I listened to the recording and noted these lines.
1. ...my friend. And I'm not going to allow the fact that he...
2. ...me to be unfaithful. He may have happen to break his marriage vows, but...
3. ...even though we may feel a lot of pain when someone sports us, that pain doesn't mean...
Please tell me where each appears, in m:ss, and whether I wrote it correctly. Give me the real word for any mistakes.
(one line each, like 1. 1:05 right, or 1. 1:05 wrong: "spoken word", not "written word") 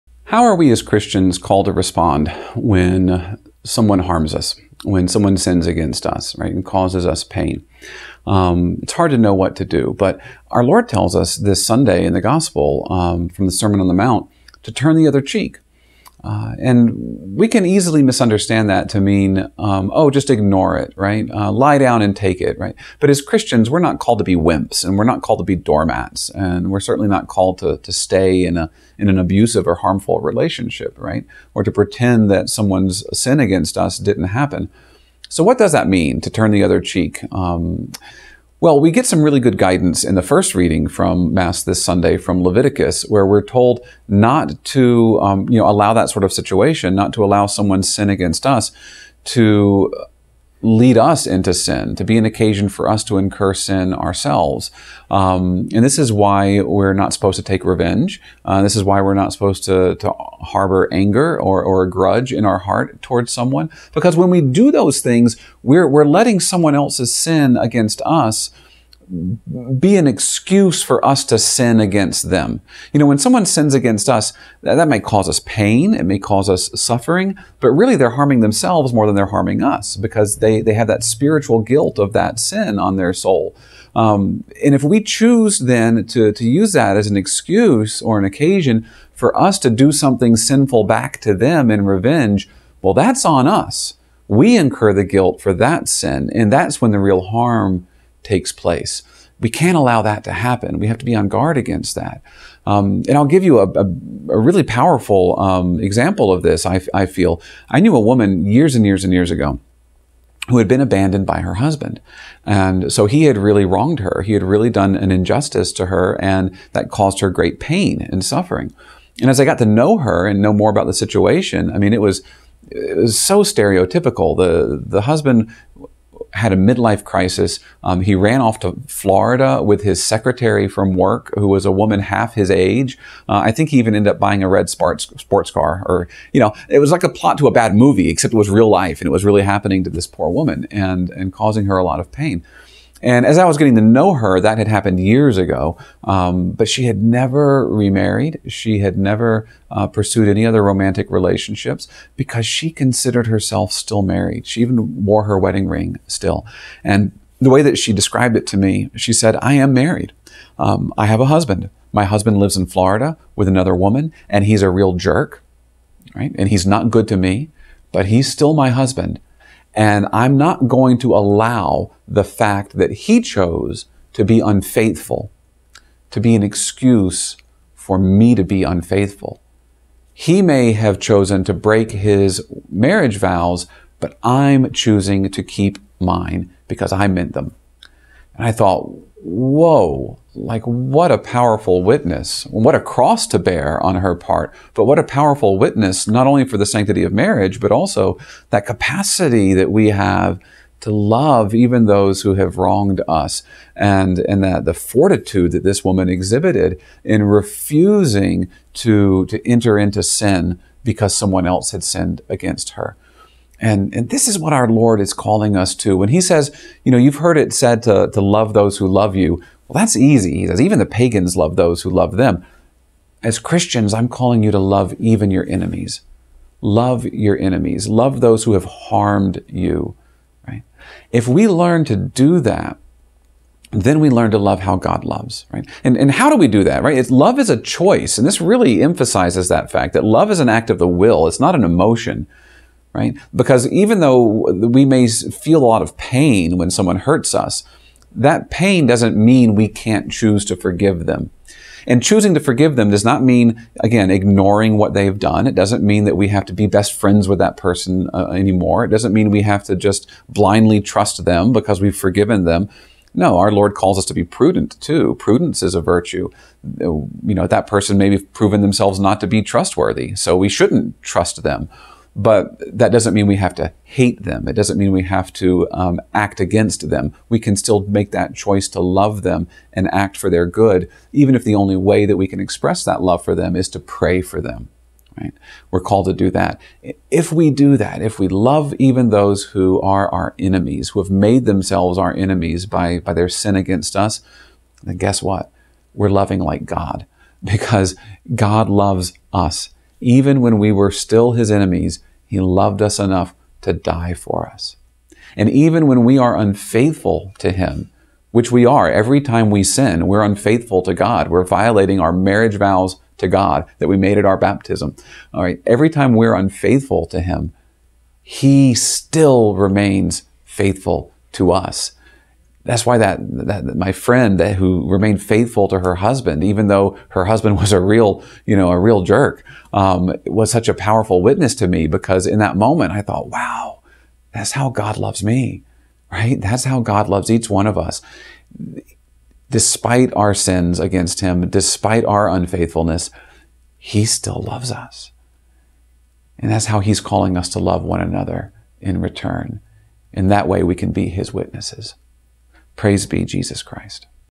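1. 2:48 wrong: "husband", not "friend"
2. 2:57 wrong: "chosen", not "happen"
3. 4:03 wrong: "hurts", not "sports".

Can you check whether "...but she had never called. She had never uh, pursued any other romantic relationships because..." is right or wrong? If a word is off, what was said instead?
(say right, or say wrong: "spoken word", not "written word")
wrong: "remarried", not "called".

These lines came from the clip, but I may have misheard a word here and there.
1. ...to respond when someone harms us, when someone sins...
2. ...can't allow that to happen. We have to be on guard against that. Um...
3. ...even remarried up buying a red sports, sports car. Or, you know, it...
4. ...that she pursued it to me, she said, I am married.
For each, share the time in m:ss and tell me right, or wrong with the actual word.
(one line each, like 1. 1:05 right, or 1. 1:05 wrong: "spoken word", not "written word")
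1. 0:01 right
2. 1:39 right
3. 2:13 wrong: "ended", not "remarried"
4. 2:37 wrong: "described", not "pursued".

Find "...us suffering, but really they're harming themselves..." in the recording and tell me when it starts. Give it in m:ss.
1:16.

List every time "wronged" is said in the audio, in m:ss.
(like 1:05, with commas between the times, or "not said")
1:53, 3:22.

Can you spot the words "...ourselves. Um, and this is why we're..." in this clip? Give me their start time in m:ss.
0:53.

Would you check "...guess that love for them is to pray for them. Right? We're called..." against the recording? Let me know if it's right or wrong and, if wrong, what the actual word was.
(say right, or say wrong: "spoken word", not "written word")
wrong: "express", not "guess".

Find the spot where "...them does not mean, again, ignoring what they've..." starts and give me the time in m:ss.
4:12.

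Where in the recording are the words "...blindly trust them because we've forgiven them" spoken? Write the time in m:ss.
4:20.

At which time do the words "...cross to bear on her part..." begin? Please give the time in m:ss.
3:12.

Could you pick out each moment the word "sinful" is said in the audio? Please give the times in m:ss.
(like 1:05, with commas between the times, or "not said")
1:30.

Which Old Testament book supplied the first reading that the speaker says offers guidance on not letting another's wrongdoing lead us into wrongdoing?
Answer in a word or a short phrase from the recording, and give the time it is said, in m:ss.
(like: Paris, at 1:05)
Leviticus, at 0:42.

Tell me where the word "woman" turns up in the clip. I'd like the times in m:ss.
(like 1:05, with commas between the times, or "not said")
1:47, 2:11, 2:20, 2:43, 3:25.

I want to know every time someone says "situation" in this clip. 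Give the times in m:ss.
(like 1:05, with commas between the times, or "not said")
0:46, 2:00.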